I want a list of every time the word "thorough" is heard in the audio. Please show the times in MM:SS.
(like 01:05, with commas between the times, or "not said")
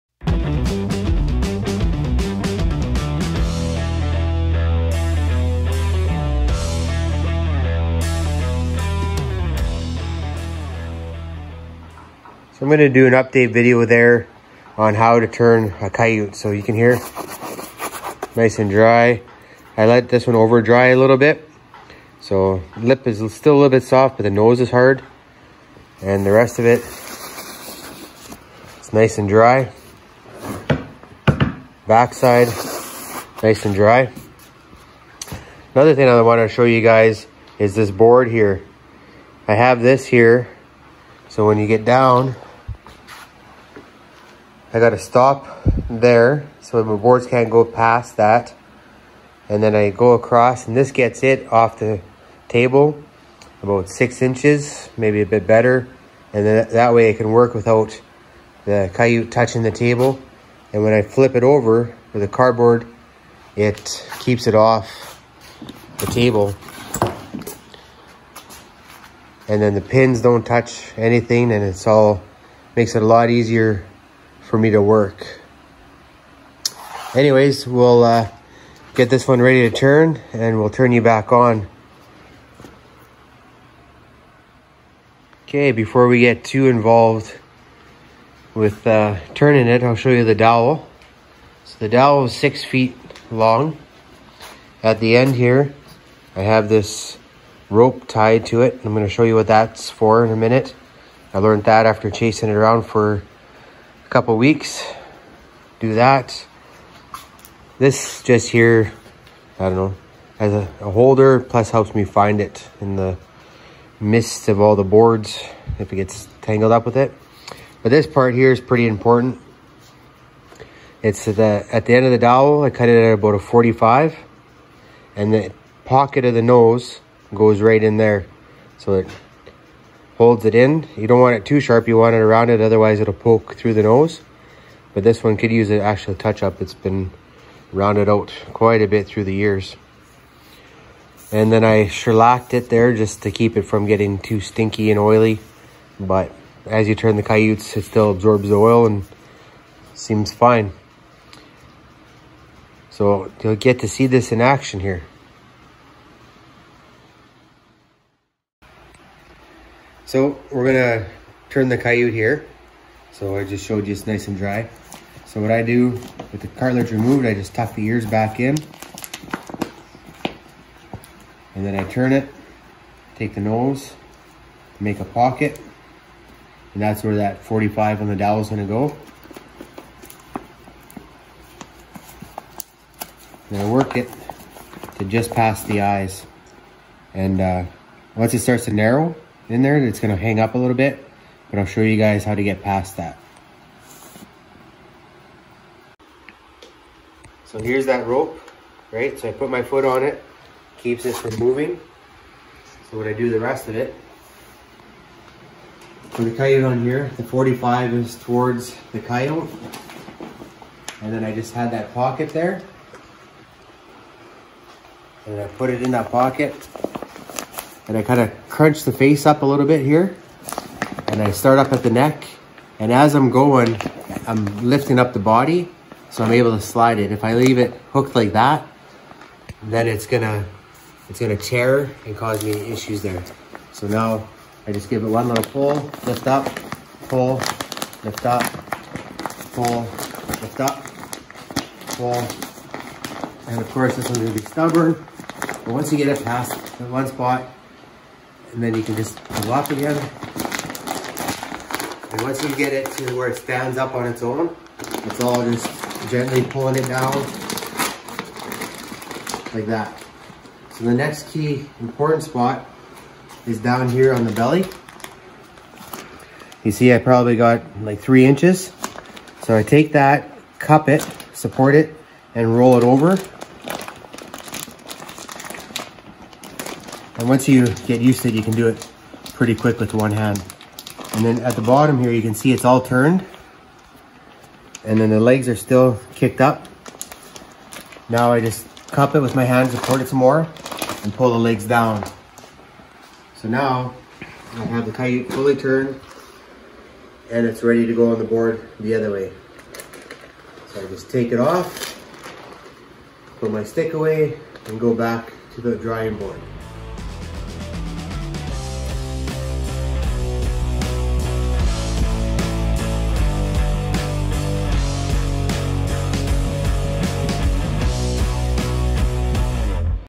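not said.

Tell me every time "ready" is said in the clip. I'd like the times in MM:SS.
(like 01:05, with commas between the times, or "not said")
01:19, 04:57.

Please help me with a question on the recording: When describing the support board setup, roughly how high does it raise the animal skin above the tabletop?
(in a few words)
6 inches.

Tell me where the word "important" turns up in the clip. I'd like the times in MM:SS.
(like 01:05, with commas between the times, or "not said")
01:58, 04:21.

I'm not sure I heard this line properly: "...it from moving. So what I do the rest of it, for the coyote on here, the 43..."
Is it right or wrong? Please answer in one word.
wrong.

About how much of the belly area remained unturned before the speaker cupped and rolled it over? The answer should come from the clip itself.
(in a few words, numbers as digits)
3 inches.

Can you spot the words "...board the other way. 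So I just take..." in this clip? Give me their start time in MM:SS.
04:58.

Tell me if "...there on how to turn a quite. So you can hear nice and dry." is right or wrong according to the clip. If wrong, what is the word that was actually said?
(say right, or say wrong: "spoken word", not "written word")
wrong: "coyote", not "quite".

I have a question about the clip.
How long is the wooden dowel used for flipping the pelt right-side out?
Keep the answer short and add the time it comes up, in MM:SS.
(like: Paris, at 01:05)
6 feet, at 01:32.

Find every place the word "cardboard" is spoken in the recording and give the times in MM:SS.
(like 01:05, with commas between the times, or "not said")
01:02.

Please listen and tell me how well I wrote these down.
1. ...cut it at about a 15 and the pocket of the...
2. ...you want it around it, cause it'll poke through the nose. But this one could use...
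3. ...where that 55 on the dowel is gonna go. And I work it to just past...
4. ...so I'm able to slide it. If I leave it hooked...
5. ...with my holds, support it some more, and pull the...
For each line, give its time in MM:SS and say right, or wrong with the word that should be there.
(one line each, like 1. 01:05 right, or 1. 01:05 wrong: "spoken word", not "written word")
1. 02:02 wrong: "45", not "15"
2. 02:11 wrong: "otherwise", not "cause"
3. 02:57 wrong: "45", not "55"
4. 03:46 right
5. 04:49 wrong: "hands", not "holds".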